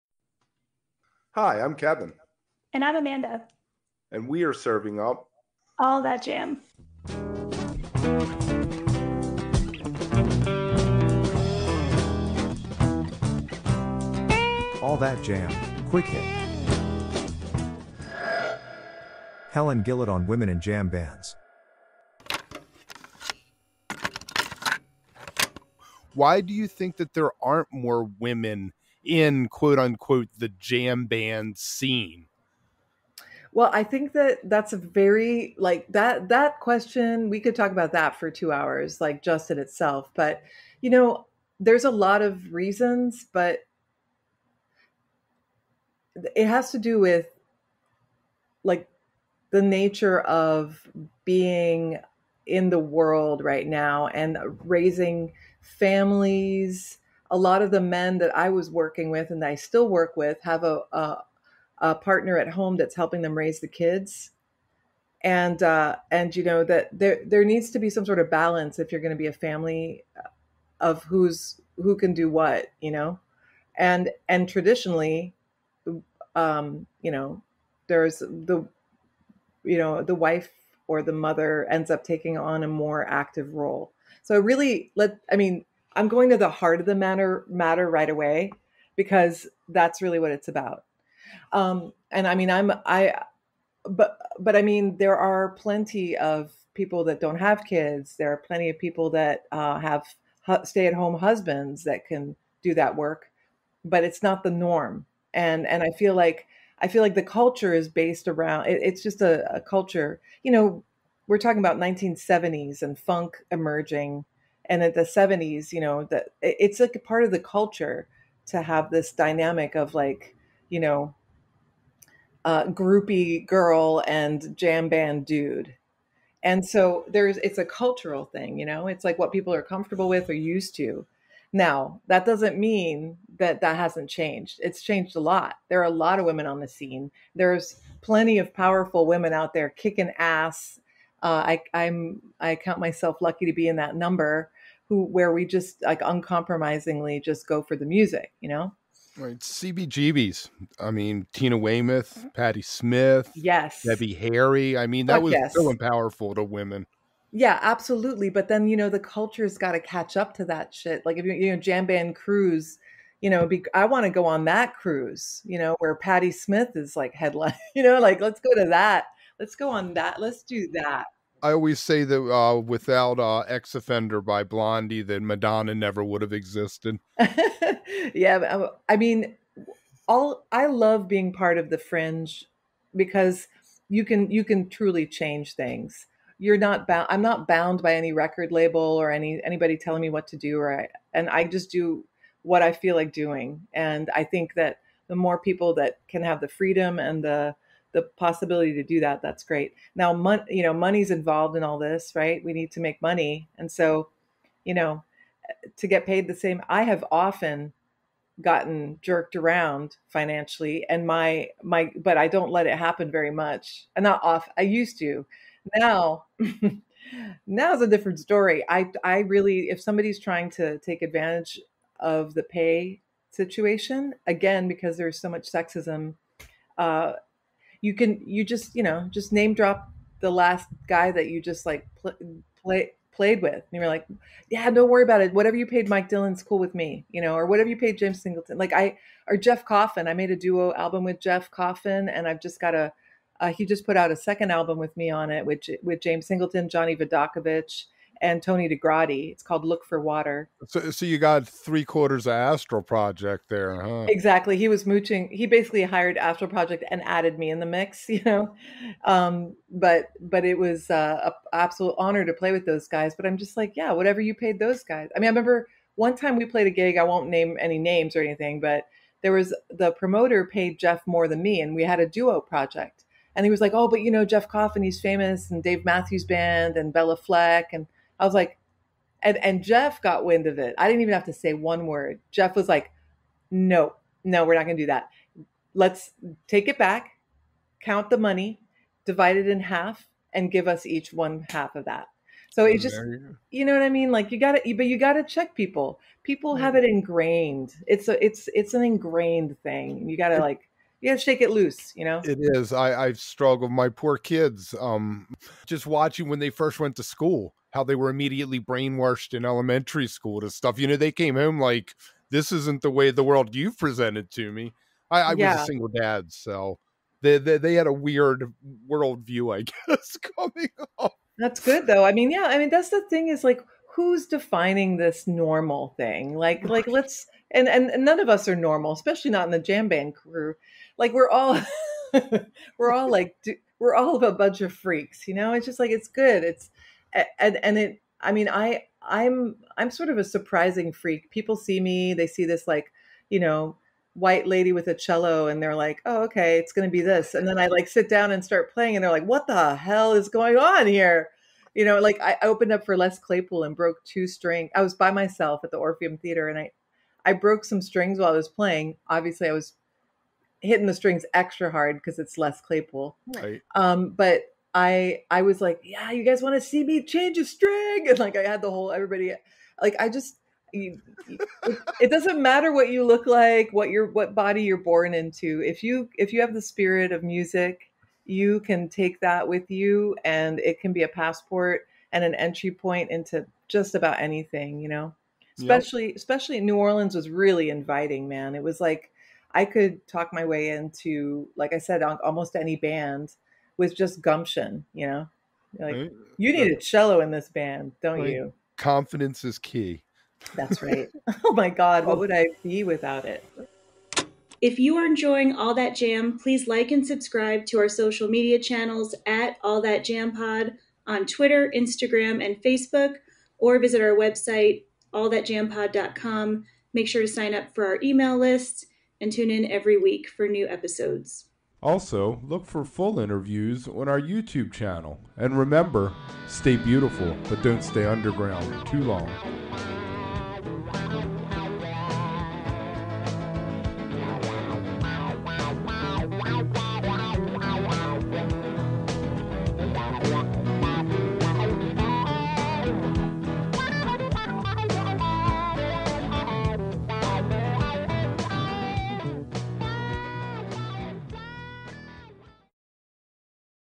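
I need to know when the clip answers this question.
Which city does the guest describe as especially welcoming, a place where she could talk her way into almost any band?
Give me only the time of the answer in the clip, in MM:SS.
06:26.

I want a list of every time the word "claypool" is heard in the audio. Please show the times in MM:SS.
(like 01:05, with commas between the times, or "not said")
05:53, 06:02.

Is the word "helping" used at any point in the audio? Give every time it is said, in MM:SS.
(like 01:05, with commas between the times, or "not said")
01:02.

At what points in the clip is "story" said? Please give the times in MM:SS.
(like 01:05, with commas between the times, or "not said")
03:38.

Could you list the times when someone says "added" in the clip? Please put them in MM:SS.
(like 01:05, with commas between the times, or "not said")
04:17.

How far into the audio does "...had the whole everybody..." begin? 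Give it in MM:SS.
06:08.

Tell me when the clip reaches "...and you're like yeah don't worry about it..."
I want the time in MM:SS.
03:53.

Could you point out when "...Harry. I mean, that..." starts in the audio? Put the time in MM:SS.
02:34.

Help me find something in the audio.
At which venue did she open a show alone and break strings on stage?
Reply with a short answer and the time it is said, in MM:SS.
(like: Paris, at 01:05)
Orpheum Theater, at 05:55.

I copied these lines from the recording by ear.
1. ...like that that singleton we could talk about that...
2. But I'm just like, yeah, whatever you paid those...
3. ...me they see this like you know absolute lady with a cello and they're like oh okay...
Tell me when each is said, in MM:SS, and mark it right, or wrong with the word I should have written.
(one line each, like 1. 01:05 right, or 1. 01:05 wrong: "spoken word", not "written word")
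1. 00:35 wrong: "question", not "singleton"
2. 04:23 right
3. 05:41 wrong: "white", not "absolute".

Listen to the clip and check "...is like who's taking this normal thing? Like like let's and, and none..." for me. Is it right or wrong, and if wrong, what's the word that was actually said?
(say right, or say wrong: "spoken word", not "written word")
wrong: "defining", not "taking".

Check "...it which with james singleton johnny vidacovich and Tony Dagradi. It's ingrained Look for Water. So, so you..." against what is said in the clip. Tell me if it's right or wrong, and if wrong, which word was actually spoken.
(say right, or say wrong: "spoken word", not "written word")
wrong: "called", not "ingrained".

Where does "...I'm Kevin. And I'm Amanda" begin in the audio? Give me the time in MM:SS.
00:01.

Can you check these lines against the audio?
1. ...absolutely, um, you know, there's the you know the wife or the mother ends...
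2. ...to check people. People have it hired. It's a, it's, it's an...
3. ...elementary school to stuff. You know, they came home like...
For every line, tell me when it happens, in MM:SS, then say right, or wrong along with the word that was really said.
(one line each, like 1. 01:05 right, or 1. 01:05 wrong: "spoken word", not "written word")
1. 01:14 wrong: "traditionally", not "absolutely"
2. 04:55 wrong: "ingrained", not "hired"
3. 05:09 right.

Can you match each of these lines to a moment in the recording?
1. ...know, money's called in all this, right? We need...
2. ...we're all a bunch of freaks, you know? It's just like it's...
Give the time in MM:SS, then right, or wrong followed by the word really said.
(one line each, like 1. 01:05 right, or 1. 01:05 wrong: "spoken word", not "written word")
1. 03:20 wrong: "involved", not "called"
2. 05:33 right.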